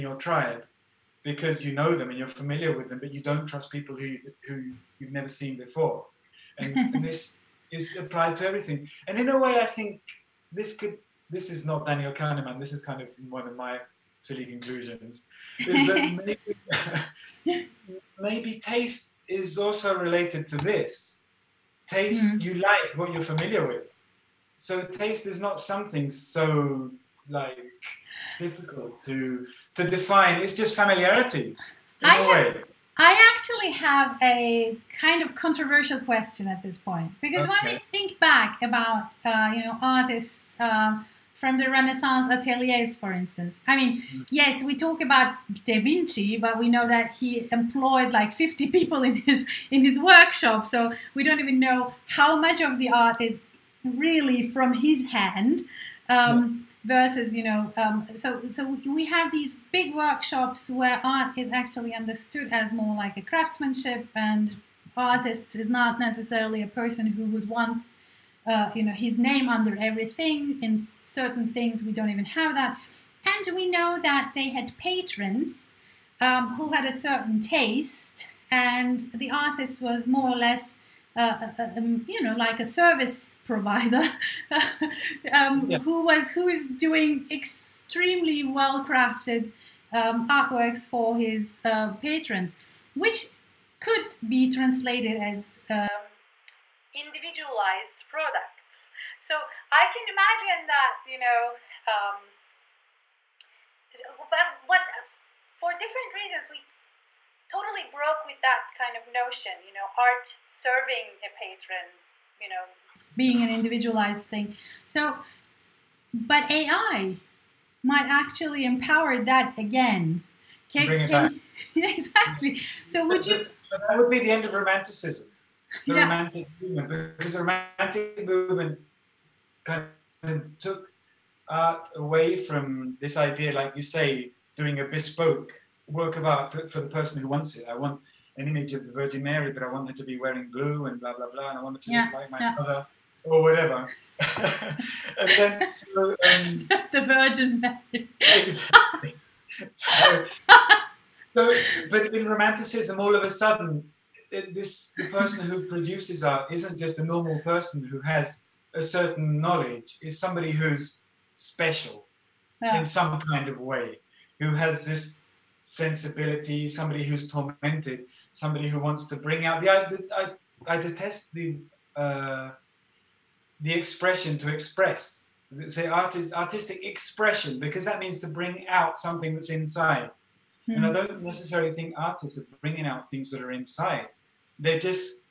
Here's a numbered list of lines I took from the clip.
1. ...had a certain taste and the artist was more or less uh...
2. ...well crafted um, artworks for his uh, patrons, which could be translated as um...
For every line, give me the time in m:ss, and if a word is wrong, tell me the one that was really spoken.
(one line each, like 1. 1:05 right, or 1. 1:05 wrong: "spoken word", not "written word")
1. 1:16 right
2. 1:28 right.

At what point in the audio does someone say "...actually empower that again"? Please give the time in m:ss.
1:58.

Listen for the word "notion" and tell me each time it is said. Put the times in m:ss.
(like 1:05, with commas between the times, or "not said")
1:49.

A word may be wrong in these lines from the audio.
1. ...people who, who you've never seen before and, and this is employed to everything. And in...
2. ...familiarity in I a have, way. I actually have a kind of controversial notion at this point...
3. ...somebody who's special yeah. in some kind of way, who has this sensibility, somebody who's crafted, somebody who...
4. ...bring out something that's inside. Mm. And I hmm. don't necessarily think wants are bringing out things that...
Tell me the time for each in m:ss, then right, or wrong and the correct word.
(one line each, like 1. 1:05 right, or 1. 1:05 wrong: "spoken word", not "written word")
1. 0:03 wrong: "applied", not "employed"
2. 0:30 wrong: "question", not "notion"
3. 2:40 wrong: "tormented", not "crafted"
4. 2:58 wrong: "artists", not "wants".